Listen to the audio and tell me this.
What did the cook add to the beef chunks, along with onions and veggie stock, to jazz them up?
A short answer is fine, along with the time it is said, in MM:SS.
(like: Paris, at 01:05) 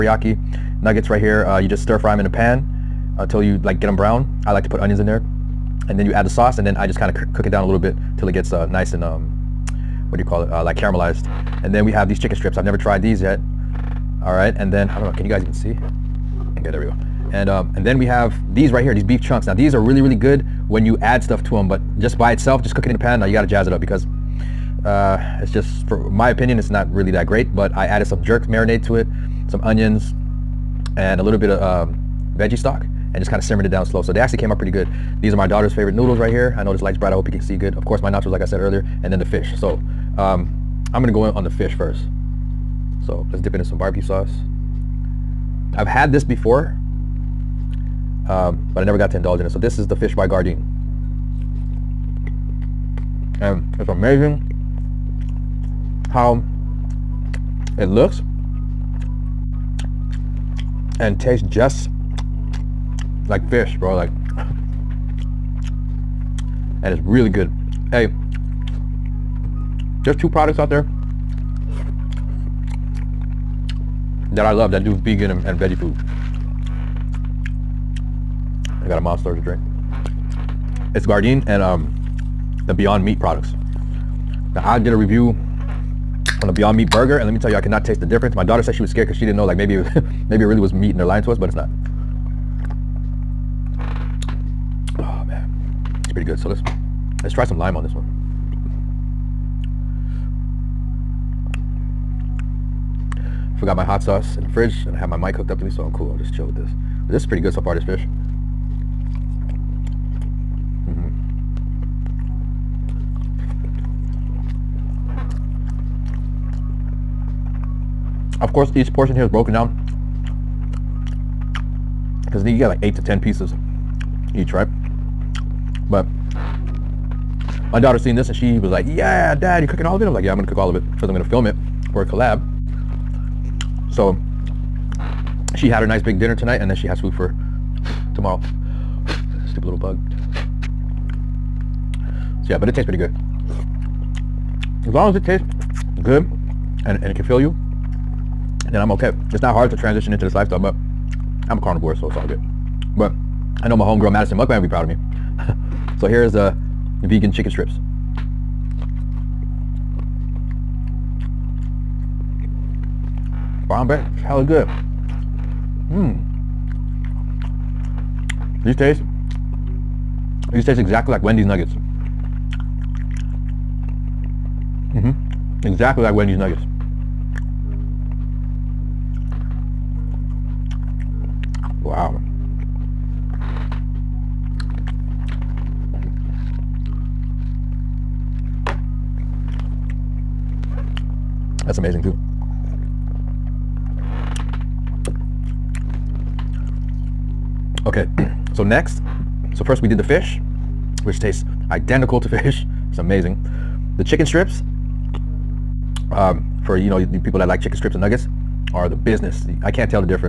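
jerk marinade, at 00:28.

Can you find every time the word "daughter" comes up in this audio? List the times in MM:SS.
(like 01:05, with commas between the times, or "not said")
00:35, 01:28, 02:07.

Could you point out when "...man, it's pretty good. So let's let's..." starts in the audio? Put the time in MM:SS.
01:35.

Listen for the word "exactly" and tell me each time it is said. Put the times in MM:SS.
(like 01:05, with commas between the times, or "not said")
02:50, 02:55.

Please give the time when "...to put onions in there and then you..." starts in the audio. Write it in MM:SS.
00:04.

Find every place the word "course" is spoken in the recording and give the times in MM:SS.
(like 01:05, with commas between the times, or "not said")
00:37, 01:58.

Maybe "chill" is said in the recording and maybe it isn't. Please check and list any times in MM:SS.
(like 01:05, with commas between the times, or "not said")
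01:46.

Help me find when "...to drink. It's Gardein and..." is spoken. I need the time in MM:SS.
01:19.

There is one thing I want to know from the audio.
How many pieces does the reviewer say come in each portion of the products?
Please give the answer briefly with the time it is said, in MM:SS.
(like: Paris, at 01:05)
8 to 10, at 02:02.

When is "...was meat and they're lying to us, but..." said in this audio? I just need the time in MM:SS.
01:30.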